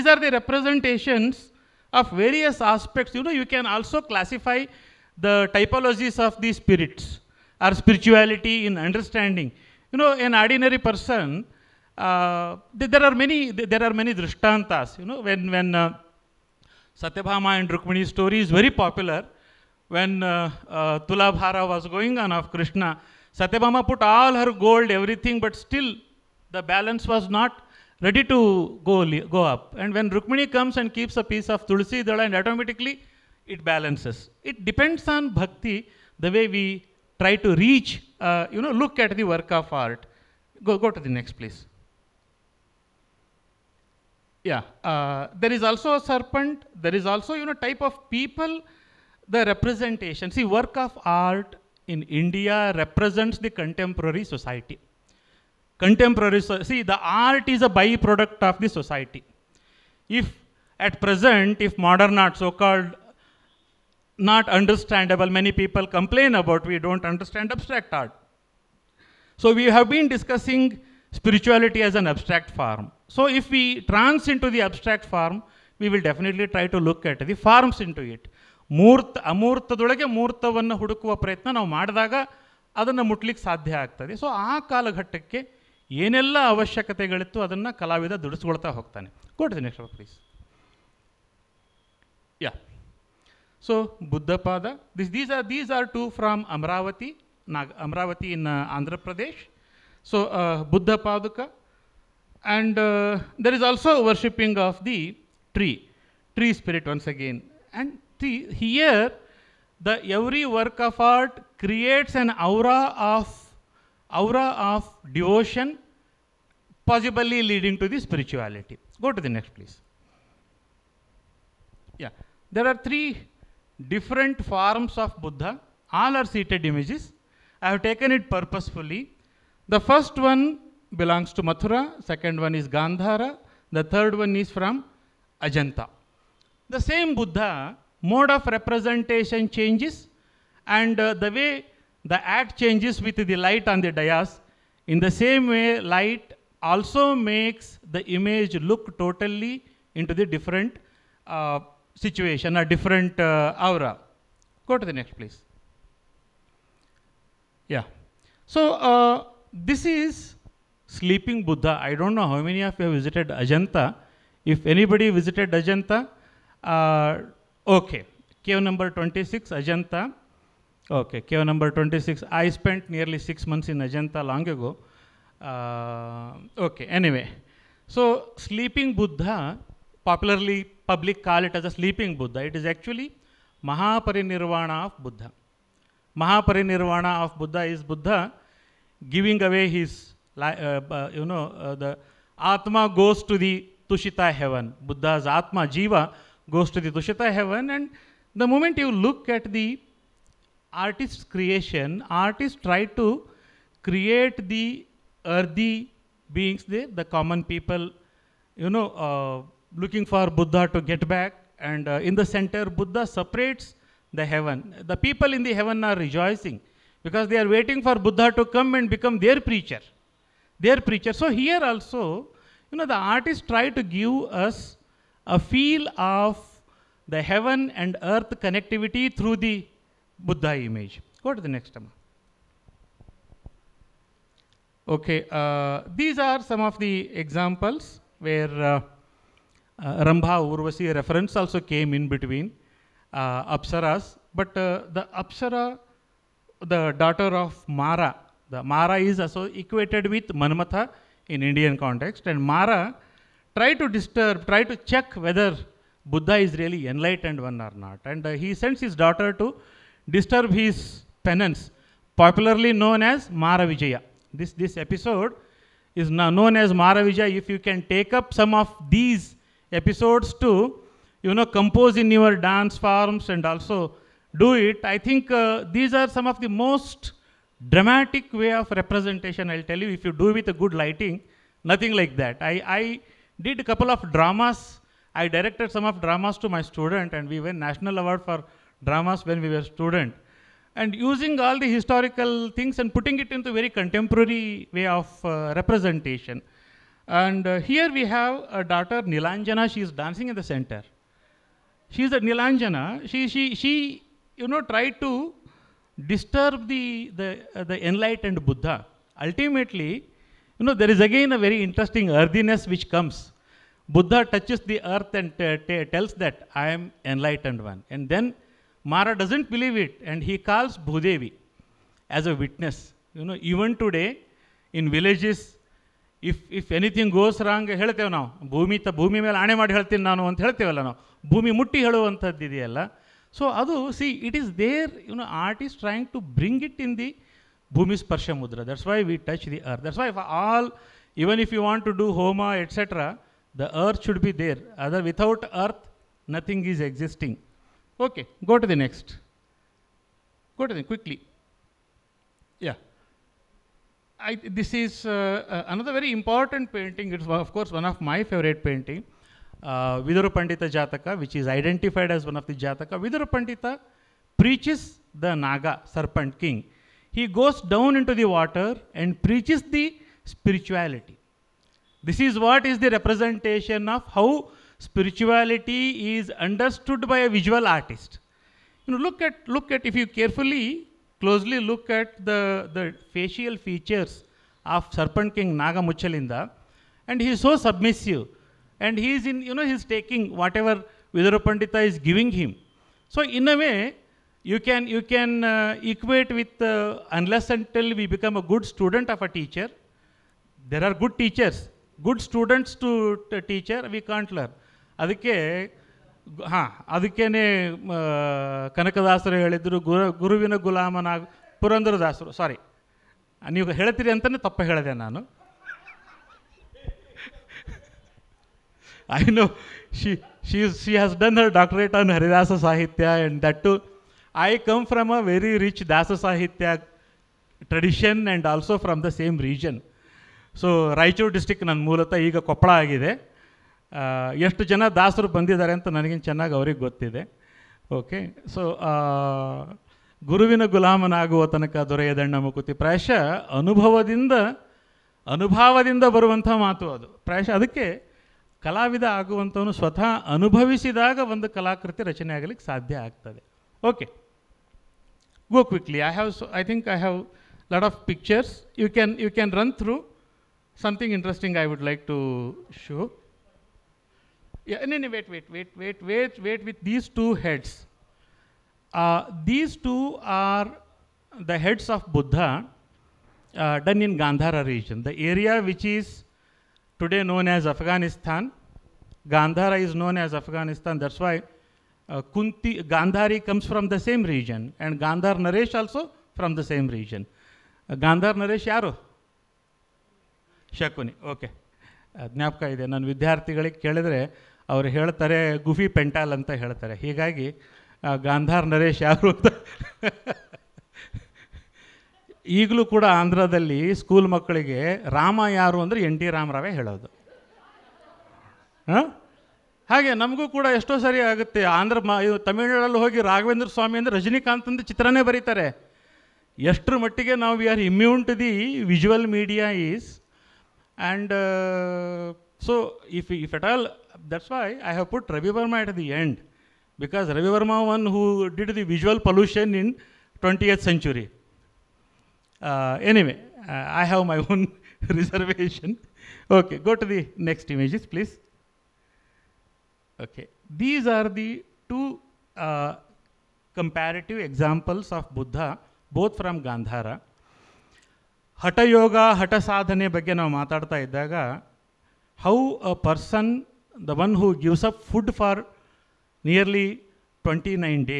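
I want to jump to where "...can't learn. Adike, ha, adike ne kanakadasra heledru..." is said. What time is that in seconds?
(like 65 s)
403 s.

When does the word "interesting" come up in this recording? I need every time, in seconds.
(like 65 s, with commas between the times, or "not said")
311 s, 461 s.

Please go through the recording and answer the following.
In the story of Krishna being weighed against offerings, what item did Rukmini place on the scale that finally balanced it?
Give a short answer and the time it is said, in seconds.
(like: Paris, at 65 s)
Tulsi Dala, at 31 s.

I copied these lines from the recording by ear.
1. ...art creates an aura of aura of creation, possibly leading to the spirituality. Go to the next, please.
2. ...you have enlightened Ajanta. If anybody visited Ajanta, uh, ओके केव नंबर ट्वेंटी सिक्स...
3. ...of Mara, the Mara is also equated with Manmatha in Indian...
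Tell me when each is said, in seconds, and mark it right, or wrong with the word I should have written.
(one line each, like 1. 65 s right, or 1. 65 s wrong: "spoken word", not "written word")
1. 110 s wrong: "devotion", not "creation"
2. 162 s wrong: "visited", not "enlightened"
3. 247 s right.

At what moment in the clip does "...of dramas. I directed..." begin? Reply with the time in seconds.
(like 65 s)
283 s.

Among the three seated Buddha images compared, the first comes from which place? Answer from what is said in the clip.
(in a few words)
Mathura.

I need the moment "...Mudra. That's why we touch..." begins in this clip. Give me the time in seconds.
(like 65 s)
338 s.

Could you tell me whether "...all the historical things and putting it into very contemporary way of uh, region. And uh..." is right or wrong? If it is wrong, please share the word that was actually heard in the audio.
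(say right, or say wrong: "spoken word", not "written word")
wrong: "representation", not "region".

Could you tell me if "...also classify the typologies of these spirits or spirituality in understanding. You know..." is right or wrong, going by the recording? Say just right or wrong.
right.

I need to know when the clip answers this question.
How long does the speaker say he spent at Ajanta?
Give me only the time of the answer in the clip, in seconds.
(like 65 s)
173 s.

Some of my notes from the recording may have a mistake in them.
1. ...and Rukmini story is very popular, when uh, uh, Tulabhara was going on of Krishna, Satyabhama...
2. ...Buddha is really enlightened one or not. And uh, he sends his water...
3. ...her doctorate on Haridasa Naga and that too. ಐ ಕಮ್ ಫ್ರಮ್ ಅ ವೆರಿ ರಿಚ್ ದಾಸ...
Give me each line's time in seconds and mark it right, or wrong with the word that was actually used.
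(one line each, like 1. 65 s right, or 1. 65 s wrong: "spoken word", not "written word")
1. 17 s right
2. 256 s wrong: "daughter", not "water"
3. 421 s wrong: "Sahitya", not "Naga".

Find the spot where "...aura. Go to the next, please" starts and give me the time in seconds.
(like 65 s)
153 s.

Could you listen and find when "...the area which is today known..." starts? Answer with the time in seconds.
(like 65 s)
475 s.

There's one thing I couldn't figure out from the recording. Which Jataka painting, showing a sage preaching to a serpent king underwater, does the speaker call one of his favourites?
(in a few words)
Vidura Pandita Jataka.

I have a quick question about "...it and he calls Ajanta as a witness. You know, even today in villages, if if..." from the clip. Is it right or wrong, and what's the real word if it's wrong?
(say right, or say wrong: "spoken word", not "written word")
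wrong: "Bhudevi", not "Ajanta".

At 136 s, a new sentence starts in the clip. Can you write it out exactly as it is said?
The same Buddha mode of representation changes and uh, the way the act changes with the light on the dais.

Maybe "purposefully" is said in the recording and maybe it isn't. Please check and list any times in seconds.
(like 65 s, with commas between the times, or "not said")
128 s.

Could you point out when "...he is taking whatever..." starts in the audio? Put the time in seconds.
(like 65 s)
389 s.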